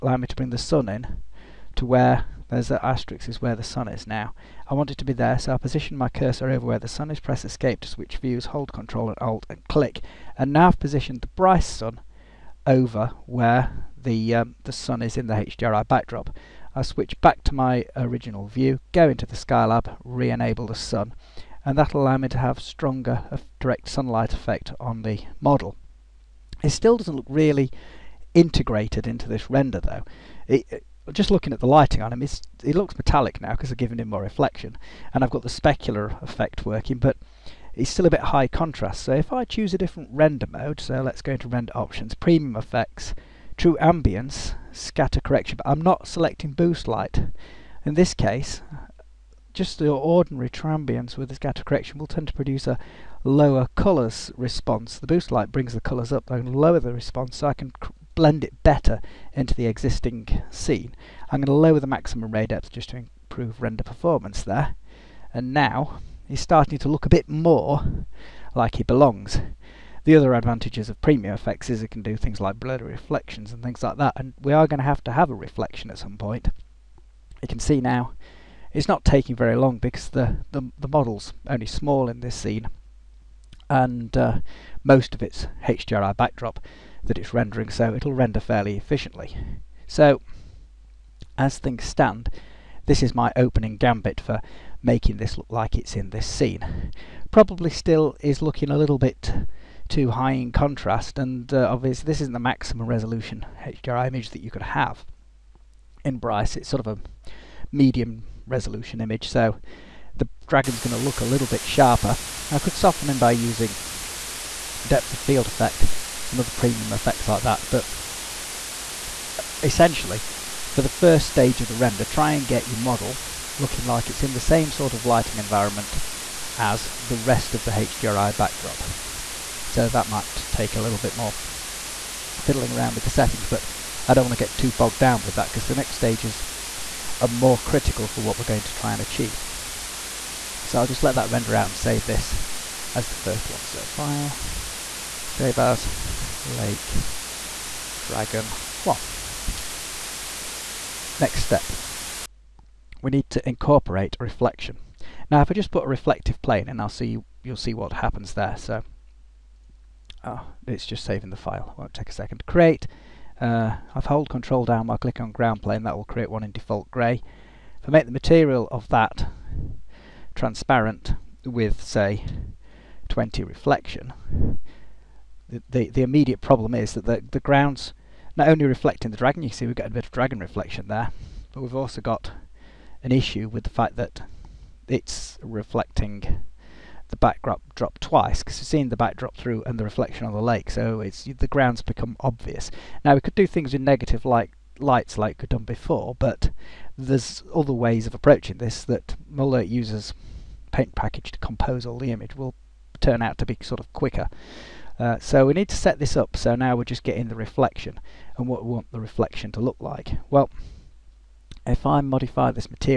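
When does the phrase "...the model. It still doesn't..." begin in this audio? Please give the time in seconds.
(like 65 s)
25 s.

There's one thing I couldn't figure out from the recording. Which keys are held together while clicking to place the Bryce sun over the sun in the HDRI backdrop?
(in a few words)
Control and Alt.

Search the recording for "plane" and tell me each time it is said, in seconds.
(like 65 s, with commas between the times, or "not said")
156 s, 165 s.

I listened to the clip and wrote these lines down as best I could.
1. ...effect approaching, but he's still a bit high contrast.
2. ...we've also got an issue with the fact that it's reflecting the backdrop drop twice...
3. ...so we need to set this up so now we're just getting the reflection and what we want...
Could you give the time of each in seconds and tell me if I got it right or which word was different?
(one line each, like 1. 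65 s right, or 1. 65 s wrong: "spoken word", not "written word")
1. 36 s wrong: "working", not "approaching"
2. 181 s right
3. 205 s right.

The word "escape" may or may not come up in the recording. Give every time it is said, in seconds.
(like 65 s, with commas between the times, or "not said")
7 s.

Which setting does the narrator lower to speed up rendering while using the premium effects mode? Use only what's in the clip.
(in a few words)
Maximum ray depth.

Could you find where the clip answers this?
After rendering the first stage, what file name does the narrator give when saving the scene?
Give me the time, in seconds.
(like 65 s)
146 s.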